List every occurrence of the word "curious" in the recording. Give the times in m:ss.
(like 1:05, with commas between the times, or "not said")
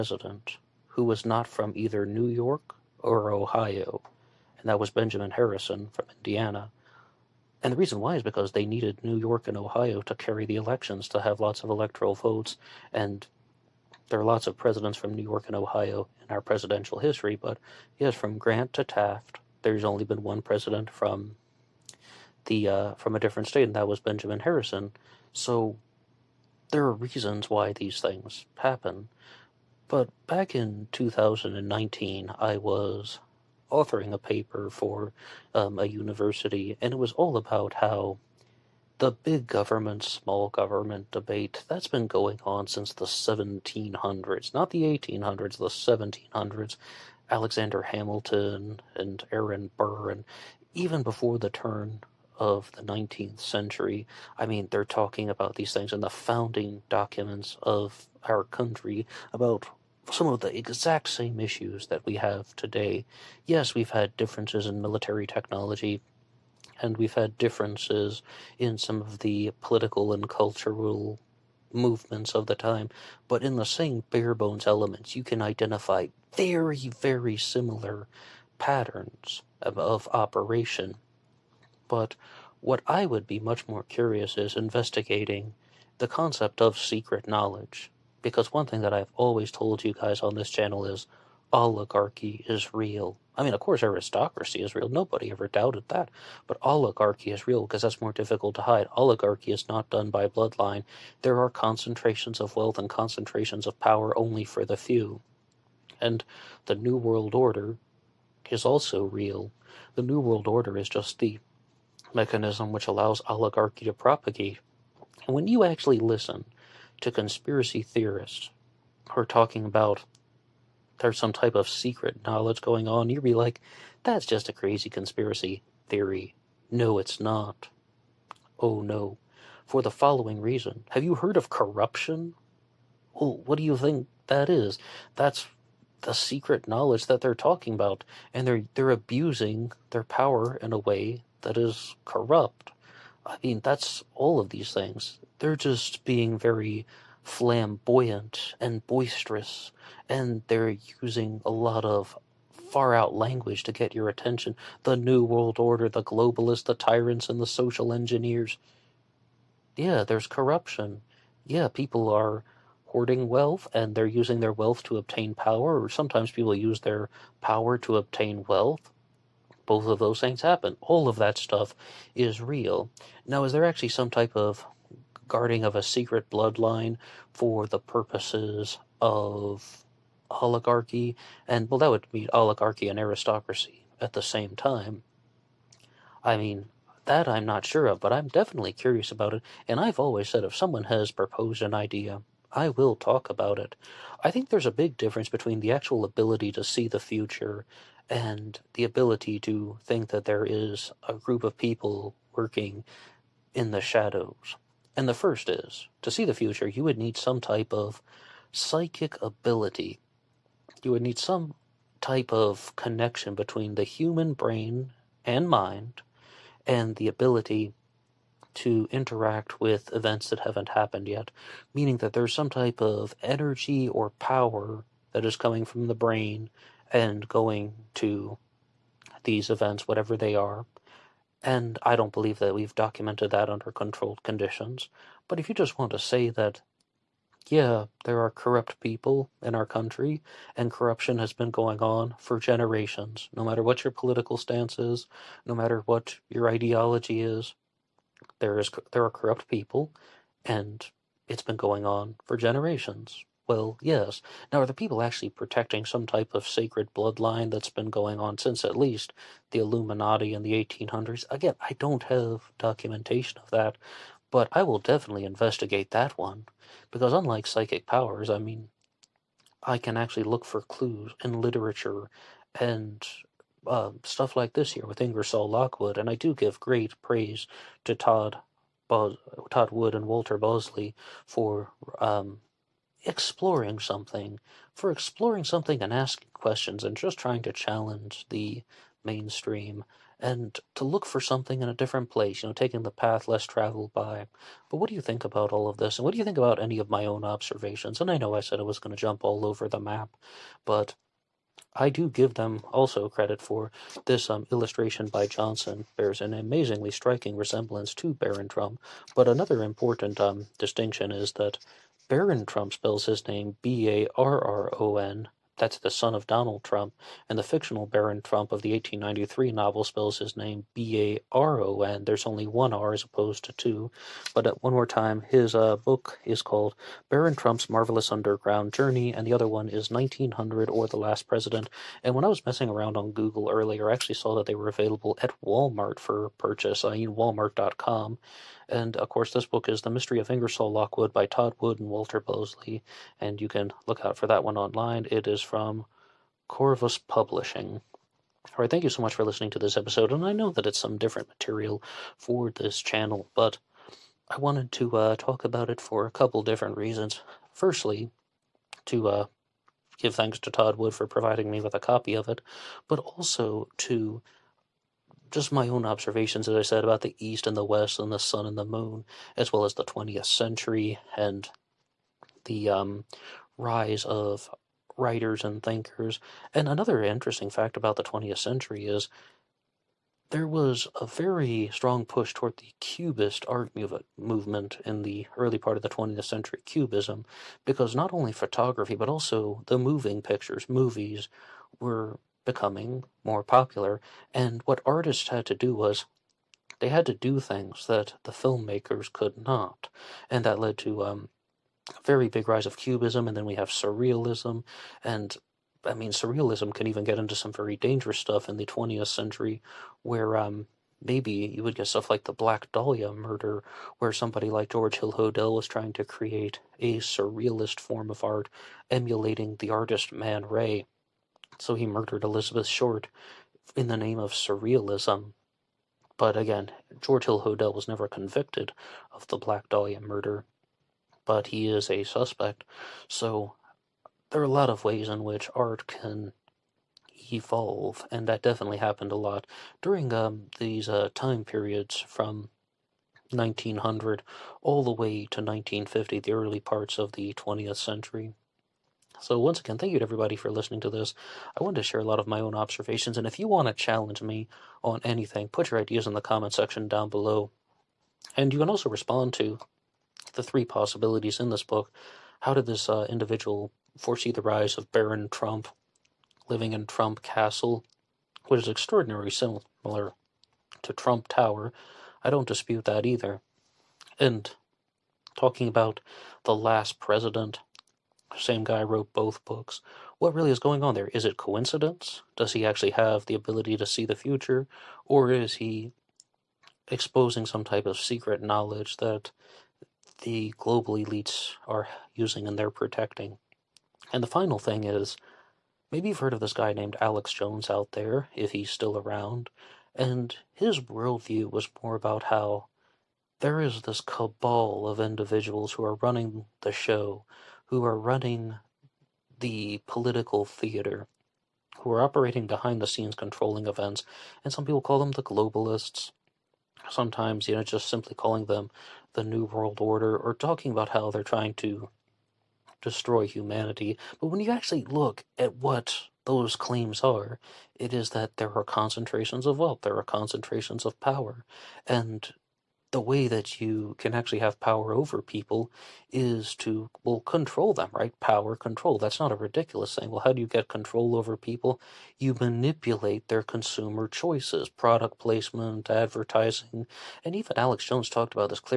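1:23, 3:08.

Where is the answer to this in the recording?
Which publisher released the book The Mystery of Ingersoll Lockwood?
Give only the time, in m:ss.
5:46.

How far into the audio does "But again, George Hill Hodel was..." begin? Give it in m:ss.
7:06.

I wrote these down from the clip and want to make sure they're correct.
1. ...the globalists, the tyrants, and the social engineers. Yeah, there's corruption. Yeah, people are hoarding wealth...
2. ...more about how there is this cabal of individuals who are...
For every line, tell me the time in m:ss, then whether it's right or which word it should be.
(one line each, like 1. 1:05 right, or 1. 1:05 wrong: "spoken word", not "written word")
1. 2:35 right
2. 8:21 right.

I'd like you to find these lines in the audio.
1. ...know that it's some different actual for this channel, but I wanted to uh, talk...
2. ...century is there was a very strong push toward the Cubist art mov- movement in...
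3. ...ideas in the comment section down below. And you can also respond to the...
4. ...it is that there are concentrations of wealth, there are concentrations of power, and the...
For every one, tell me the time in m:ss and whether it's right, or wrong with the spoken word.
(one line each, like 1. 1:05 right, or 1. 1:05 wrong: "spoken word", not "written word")
1. 5:50 wrong: "material", not "actual"
2. 6:18 right
3. 7:35 right
4. 8:47 right.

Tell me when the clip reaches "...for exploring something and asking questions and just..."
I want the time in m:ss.
4:44.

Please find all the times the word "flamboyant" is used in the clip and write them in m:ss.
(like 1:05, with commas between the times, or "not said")
2:27.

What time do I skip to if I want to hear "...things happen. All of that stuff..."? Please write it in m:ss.
2:50.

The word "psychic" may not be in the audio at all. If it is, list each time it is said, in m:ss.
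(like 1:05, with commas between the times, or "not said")
3:28, 4:27.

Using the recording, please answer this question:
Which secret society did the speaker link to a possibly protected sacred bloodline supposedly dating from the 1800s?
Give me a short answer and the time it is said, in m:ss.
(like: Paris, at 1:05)
The Illuminati, at 4:19.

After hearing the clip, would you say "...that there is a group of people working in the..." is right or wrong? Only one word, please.
right.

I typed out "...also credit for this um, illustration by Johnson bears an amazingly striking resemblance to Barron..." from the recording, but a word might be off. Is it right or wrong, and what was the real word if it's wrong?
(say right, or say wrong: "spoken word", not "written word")
right.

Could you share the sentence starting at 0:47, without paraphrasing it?
Alexander Hamilton and Aaron Burr, and even before the turn of the 19th century.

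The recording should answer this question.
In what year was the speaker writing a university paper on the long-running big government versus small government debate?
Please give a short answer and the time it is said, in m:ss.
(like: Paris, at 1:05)
2019, at 0:30.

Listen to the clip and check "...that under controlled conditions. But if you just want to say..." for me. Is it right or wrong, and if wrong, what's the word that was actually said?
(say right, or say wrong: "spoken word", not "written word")
right.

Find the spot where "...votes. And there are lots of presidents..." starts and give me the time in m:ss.
0:12.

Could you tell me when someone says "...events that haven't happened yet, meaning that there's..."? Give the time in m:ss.
3:39.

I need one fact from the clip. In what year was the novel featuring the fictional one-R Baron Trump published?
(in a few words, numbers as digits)
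1893.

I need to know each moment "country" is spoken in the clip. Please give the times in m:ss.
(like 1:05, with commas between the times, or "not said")
0:58, 3:59.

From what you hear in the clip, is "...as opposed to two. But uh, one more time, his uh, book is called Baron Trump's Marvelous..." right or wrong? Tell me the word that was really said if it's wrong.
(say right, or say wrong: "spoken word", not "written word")
right.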